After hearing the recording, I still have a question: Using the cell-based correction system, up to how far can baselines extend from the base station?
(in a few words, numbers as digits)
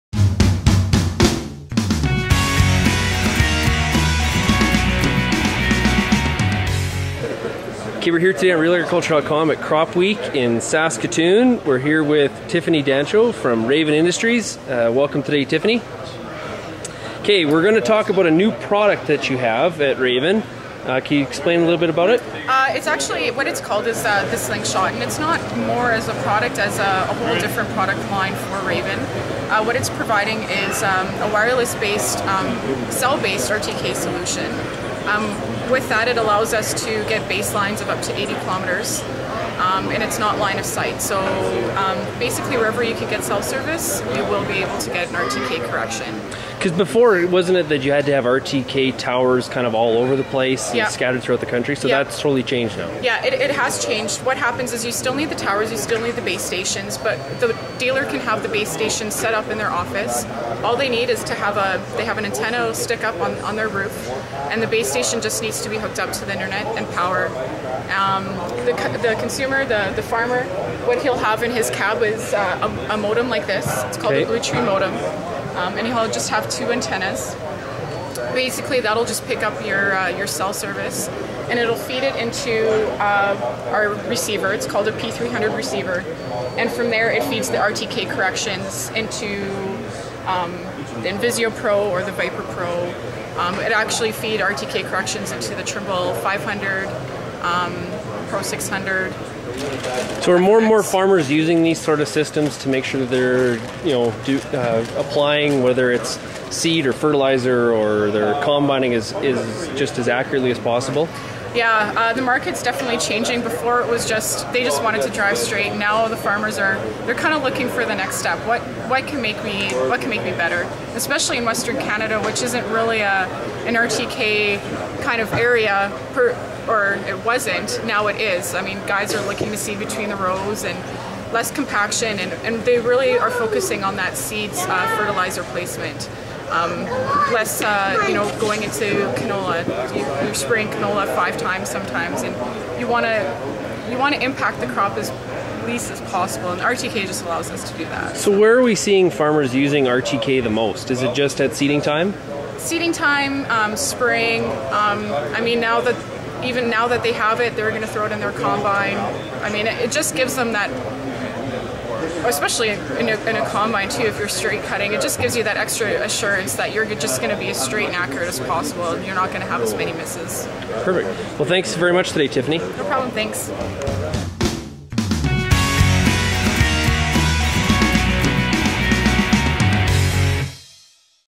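80 kilometers.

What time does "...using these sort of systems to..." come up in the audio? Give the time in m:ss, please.
1:41.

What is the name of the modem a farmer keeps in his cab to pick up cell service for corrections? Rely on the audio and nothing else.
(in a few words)
Blue Tree modem.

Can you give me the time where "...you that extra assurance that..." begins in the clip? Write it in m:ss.
2:45.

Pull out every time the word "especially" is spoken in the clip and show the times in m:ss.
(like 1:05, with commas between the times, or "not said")
2:00, 2:42.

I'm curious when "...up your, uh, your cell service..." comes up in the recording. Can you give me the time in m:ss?
1:19.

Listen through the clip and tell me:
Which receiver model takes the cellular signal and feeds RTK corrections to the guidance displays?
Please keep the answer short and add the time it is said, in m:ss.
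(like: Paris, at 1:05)
P300, at 1:24.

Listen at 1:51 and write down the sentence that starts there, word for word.
Yeah, uh, the market's definitely changing.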